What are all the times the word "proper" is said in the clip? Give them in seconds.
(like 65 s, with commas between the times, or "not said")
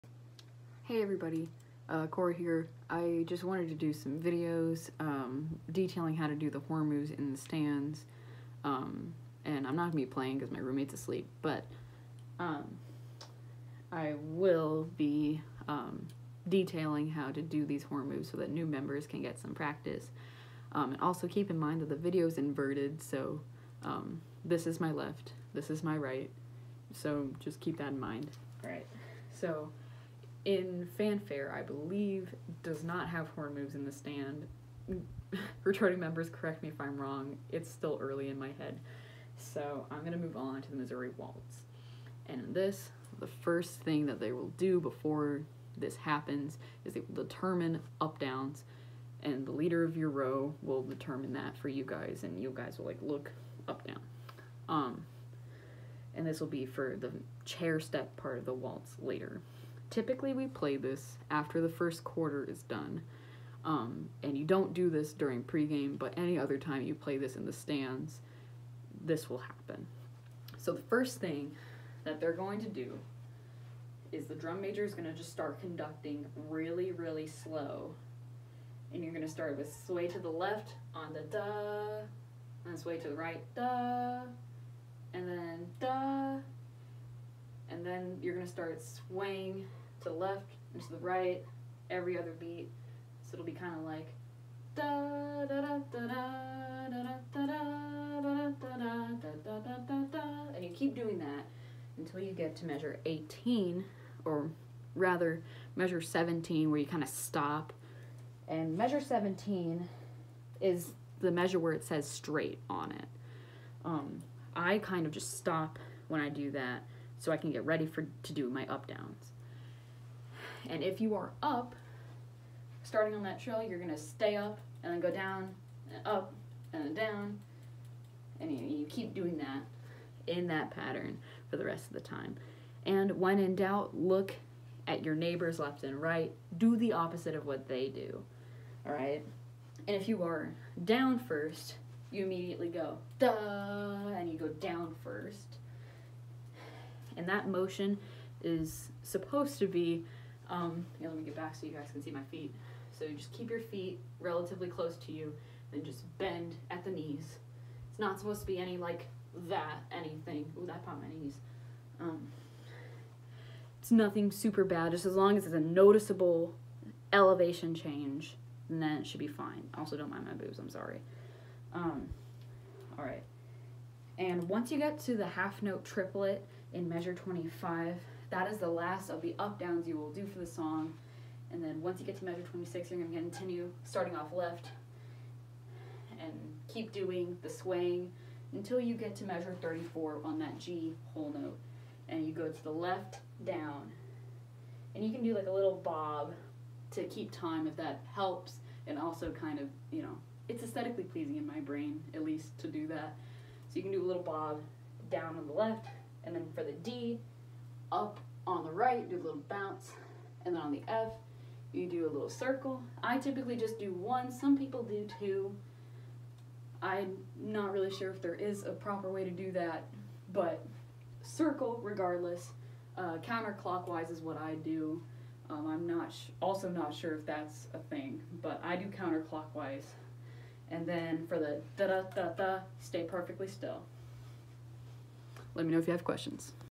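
218 s.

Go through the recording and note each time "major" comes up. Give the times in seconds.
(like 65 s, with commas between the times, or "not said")
74 s.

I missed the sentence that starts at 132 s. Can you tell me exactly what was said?
And when in doubt, look at your neighbors left and right.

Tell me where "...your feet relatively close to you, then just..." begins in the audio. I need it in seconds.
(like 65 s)
153 s.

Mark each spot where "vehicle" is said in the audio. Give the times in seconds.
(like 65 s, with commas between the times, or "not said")
not said.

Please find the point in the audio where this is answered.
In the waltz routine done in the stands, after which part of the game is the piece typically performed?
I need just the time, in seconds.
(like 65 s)
61 s.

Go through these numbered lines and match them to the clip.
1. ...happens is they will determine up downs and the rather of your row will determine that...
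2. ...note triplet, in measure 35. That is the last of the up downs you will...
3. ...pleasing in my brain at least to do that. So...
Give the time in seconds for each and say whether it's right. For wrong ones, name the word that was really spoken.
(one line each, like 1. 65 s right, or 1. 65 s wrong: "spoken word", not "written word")
1. 45 s wrong: "leader", not "rather"
2. 175 s wrong: "25", not "35"
3. 201 s right.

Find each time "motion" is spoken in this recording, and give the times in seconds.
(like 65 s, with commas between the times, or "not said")
147 s.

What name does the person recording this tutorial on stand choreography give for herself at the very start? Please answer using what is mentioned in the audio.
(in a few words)
Cora.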